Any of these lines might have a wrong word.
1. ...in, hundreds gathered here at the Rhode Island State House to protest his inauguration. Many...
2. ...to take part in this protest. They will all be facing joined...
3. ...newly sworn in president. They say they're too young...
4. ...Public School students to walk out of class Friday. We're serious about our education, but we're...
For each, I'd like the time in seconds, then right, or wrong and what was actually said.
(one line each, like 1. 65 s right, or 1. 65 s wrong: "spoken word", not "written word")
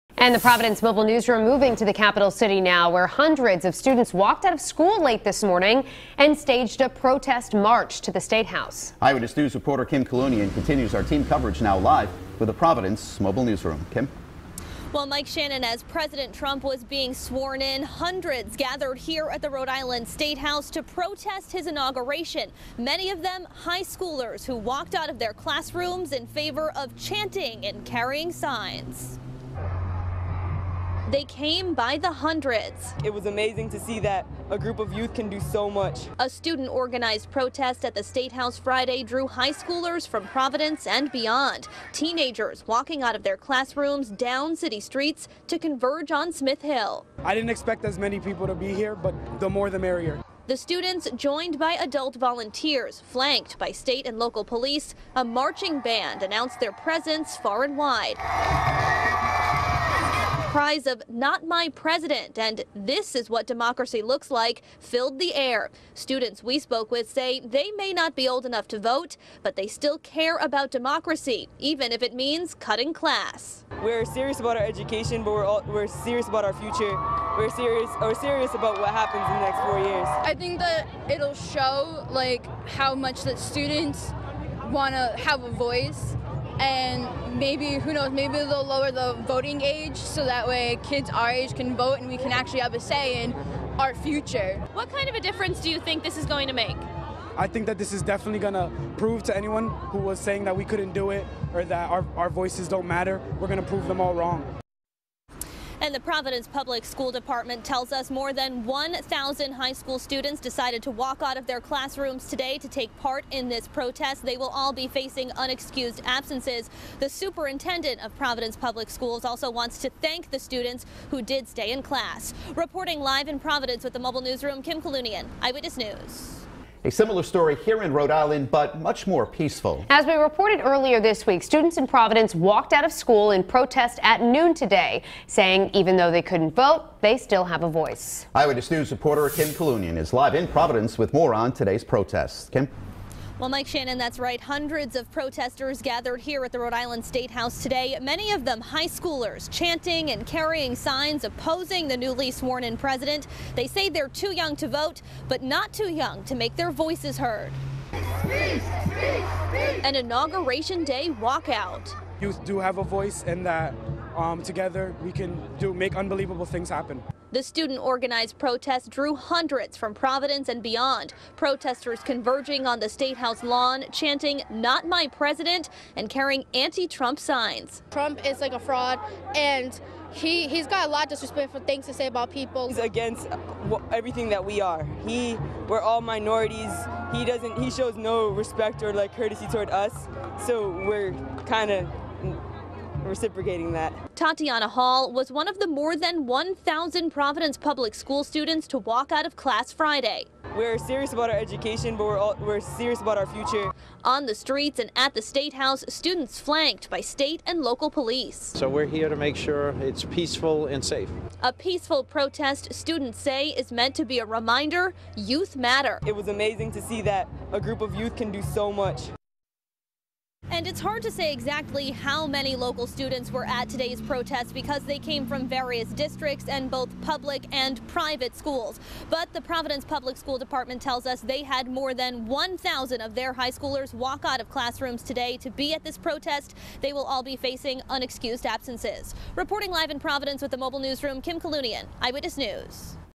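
1. 17 s right
2. 112 s wrong: "unexcused", not "joined"
3. 151 s right
4. 197 s right.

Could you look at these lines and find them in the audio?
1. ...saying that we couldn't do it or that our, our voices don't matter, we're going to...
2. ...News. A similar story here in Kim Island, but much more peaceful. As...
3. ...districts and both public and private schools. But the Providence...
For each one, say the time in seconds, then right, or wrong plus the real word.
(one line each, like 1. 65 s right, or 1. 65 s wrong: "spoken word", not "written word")
1. 100 s right
2. 125 s wrong: "Rhode", not "Kim"
3. 225 s right.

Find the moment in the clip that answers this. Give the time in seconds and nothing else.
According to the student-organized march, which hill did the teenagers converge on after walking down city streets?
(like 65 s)
46 s.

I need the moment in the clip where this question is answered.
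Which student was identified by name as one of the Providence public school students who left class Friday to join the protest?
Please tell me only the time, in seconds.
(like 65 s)
194 s.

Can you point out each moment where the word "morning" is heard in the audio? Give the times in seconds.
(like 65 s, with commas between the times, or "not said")
5 s.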